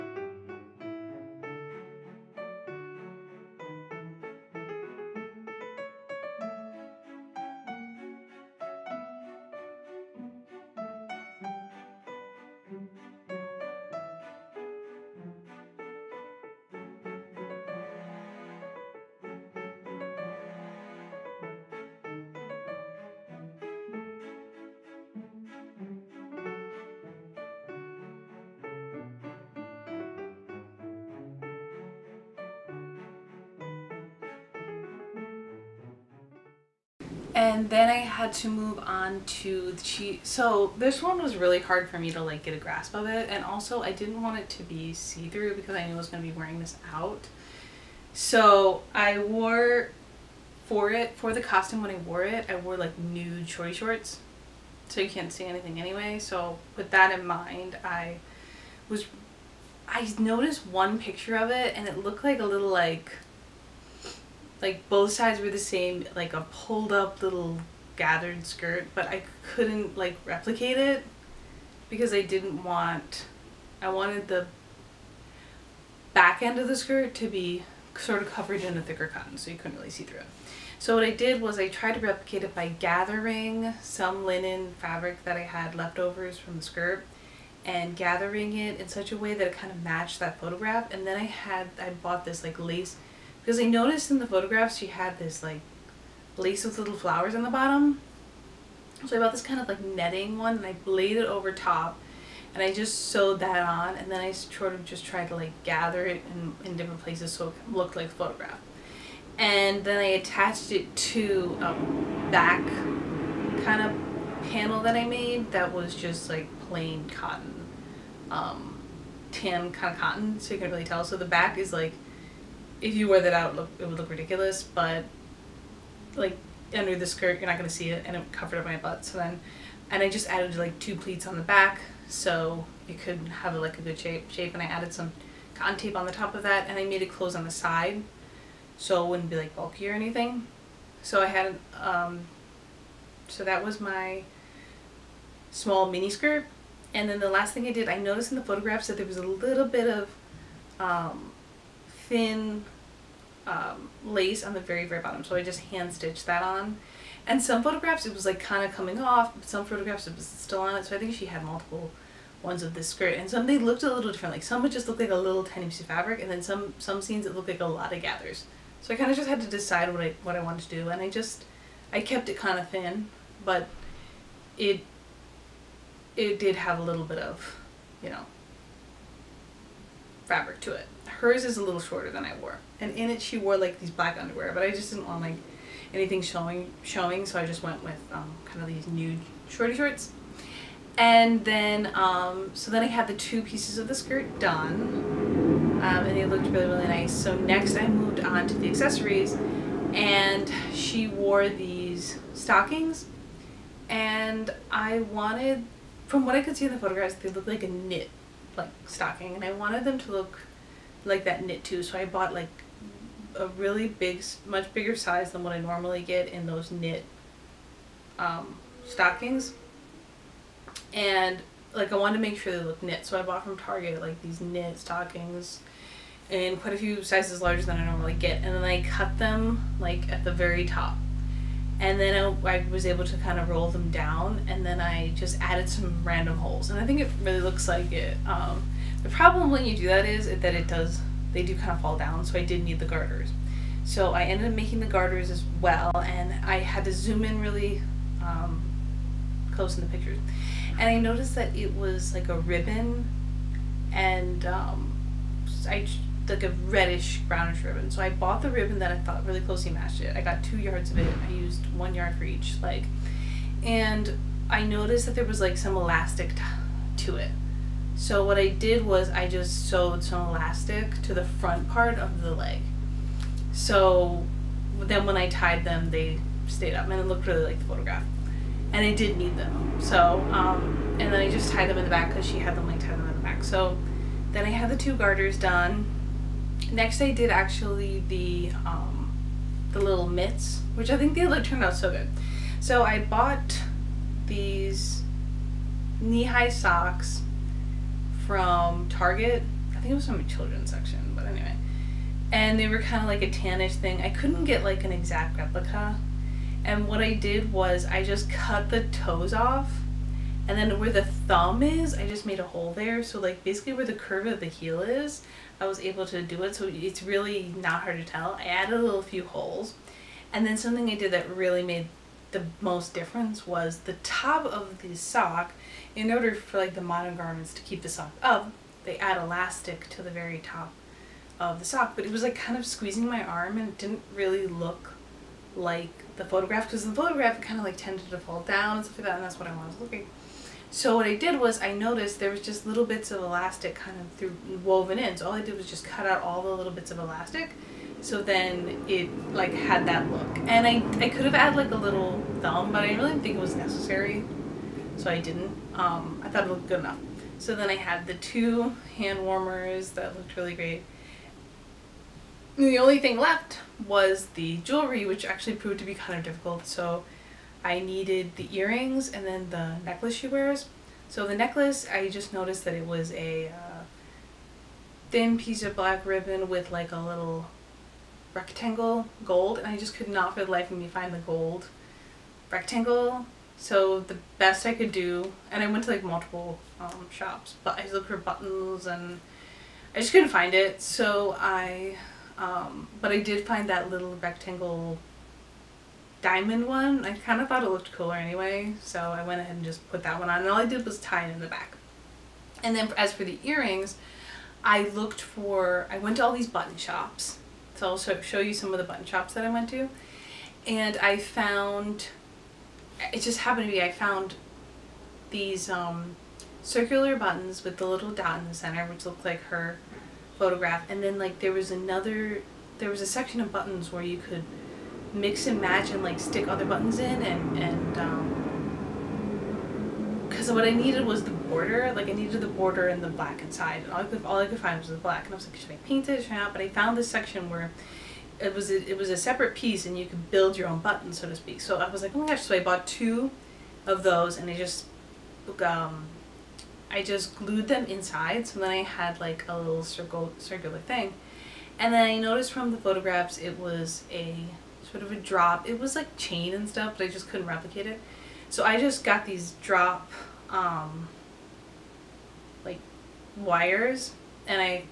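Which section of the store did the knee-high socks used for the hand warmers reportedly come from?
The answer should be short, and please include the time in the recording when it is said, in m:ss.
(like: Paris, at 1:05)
Children's section, at 5:00.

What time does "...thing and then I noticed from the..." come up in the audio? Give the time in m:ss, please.
7:30.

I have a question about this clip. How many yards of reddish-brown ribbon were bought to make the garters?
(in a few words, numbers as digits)
2.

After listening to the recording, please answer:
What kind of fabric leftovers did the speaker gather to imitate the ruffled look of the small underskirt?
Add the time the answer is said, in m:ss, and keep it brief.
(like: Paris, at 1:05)
Linen, at 1:24.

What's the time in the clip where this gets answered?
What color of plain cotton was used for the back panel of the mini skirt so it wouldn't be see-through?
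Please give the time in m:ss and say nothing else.
1:59.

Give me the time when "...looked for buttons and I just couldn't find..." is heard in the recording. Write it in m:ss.
6:27.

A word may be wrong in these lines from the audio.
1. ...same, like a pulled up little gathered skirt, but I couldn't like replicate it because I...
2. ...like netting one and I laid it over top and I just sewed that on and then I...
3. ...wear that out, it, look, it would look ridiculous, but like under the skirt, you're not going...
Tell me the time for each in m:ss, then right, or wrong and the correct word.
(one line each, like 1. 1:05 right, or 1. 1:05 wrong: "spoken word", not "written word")
1. 1:05 right
2. 1:39 right
3. 2:03 right.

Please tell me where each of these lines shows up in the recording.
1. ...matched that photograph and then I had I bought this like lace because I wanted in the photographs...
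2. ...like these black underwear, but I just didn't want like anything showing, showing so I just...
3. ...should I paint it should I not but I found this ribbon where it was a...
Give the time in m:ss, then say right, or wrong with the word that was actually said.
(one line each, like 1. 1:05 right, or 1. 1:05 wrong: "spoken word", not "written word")
1. 1:29 wrong: "noticed", not "wanted"
2. 3:03 right
3. 7:15 wrong: "section", not "ribbon".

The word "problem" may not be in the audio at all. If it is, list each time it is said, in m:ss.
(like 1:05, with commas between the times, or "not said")
3:59.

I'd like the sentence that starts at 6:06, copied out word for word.
So I needed the earrings and then the necklace she wears.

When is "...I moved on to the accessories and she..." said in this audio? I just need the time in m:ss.
3:17.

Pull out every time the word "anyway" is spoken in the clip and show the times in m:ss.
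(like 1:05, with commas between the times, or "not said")
0:55, 5:01, 6:38.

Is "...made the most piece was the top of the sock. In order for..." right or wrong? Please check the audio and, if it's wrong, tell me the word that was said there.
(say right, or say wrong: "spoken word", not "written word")
wrong: "difference", not "piece".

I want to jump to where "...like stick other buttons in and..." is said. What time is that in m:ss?
7:06.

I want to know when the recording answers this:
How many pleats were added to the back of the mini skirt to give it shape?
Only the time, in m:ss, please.
2:10.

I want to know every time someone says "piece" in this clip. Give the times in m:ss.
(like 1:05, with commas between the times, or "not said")
2:45, 3:13, 6:15, 7:19.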